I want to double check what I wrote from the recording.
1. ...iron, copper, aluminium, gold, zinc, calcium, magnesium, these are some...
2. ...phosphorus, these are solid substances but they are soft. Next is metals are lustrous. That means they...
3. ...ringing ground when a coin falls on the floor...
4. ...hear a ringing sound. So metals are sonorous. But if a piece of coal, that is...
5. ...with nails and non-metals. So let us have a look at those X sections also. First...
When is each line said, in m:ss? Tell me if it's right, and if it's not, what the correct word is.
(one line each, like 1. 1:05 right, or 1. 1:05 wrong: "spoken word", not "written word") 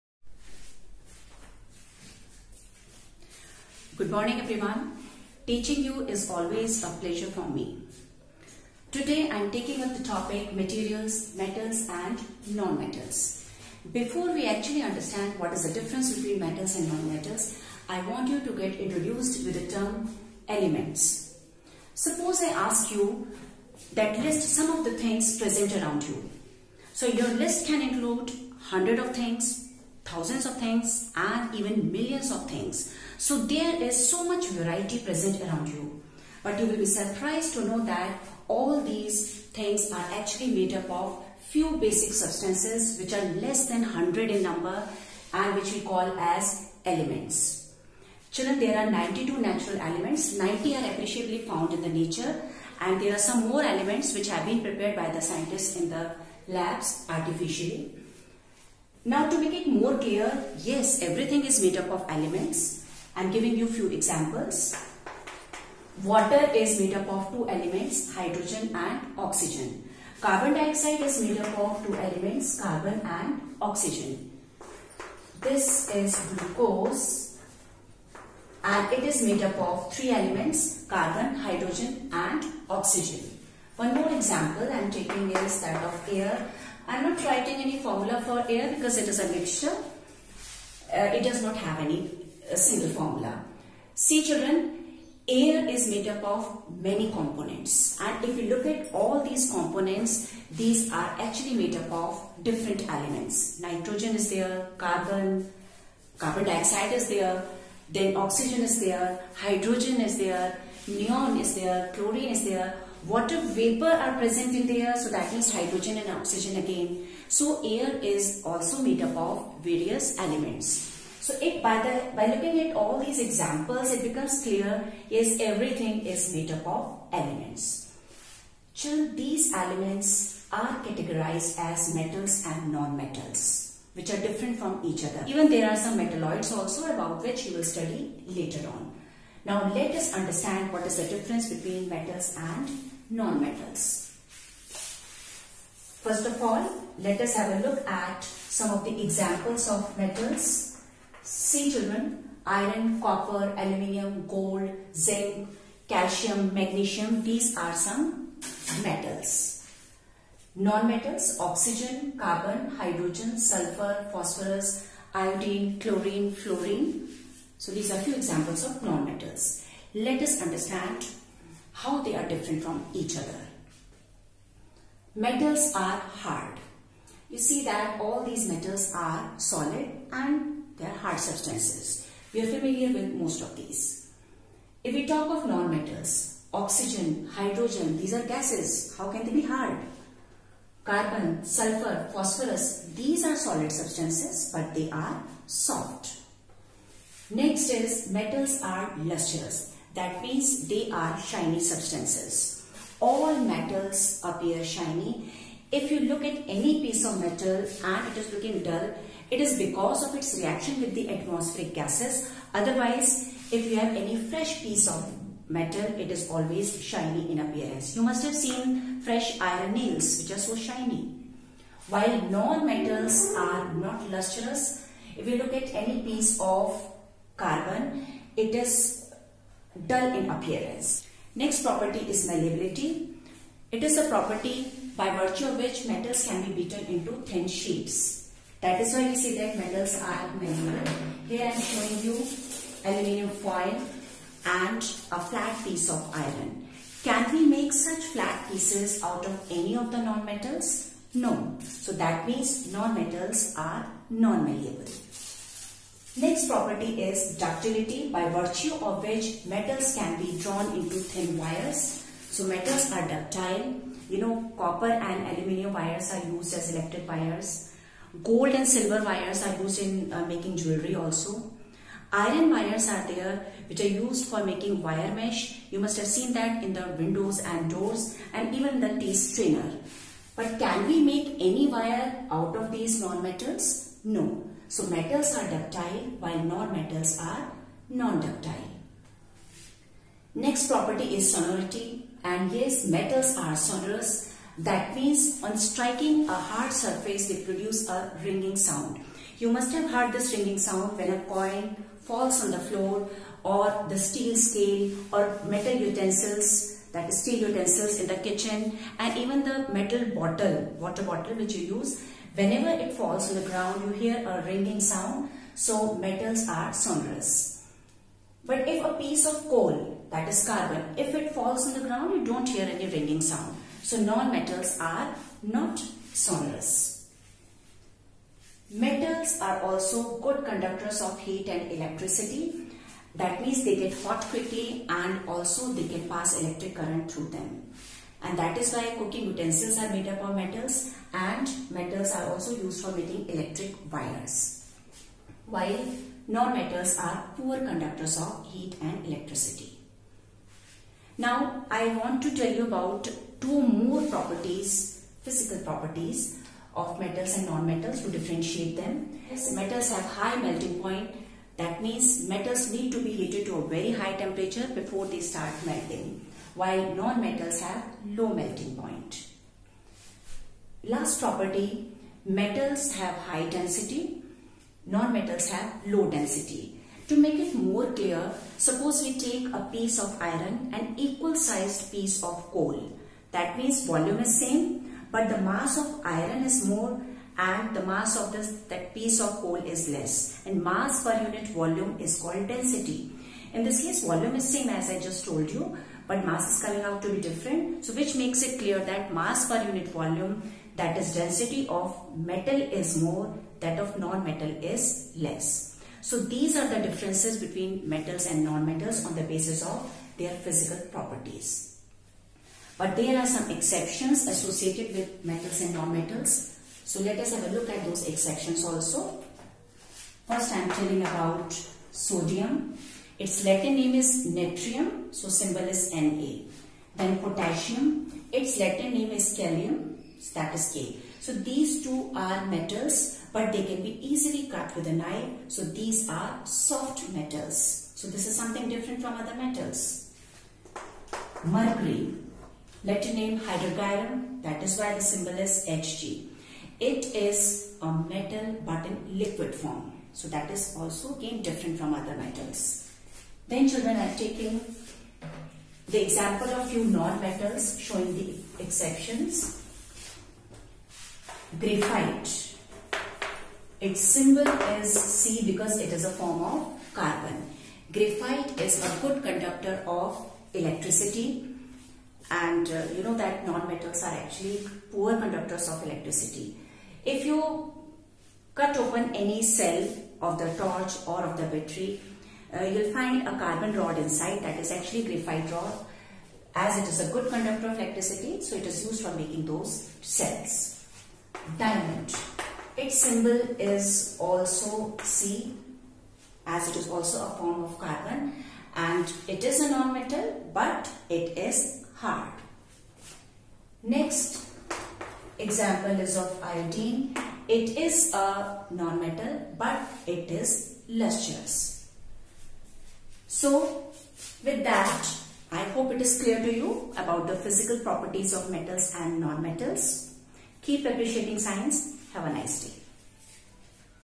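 1. 2:32 right
2. 3:12 right
3. 5:00 wrong: "sound", not "ground"
4. 5:13 right
5. 6:54 wrong: "metals", not "nails".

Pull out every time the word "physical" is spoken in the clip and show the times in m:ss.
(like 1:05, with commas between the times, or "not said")
5:55, 6:50, 8:37.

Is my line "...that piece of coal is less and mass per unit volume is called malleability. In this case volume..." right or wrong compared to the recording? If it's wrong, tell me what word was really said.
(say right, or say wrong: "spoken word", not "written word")
wrong: "density", not "malleability".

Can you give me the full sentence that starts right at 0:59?
Now to make it more clear, yes, everything is made up of elements.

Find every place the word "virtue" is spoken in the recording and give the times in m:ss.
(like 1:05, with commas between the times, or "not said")
3:55, 4:18.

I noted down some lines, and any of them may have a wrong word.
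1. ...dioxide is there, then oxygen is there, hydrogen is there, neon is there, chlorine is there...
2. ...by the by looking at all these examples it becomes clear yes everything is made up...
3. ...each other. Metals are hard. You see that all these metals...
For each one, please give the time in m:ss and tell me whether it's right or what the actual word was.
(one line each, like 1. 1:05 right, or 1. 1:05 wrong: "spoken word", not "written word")
1. 1:46 right
2. 2:01 right
3. 2:52 right.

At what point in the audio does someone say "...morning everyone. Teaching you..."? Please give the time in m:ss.
0:04.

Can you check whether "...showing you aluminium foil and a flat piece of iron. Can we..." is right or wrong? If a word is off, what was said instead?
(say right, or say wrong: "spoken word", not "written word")
right.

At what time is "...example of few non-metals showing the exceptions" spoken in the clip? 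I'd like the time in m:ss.
7:36.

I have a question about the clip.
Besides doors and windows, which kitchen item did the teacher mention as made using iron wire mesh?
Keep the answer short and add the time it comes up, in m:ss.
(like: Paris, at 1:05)
Tea strainer, at 4:38.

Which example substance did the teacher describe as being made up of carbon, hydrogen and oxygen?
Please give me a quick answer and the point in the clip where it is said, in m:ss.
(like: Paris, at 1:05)
Glucose, at 1:16.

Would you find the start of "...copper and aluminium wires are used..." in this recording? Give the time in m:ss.
4:24.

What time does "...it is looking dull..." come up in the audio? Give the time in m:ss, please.
3:28.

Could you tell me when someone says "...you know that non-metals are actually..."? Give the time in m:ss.
7:52.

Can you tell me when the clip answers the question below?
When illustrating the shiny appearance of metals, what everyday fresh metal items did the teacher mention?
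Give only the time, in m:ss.
3:39.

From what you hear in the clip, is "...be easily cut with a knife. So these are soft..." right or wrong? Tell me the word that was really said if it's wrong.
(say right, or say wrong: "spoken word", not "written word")
right.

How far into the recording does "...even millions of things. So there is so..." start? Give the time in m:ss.
0:31.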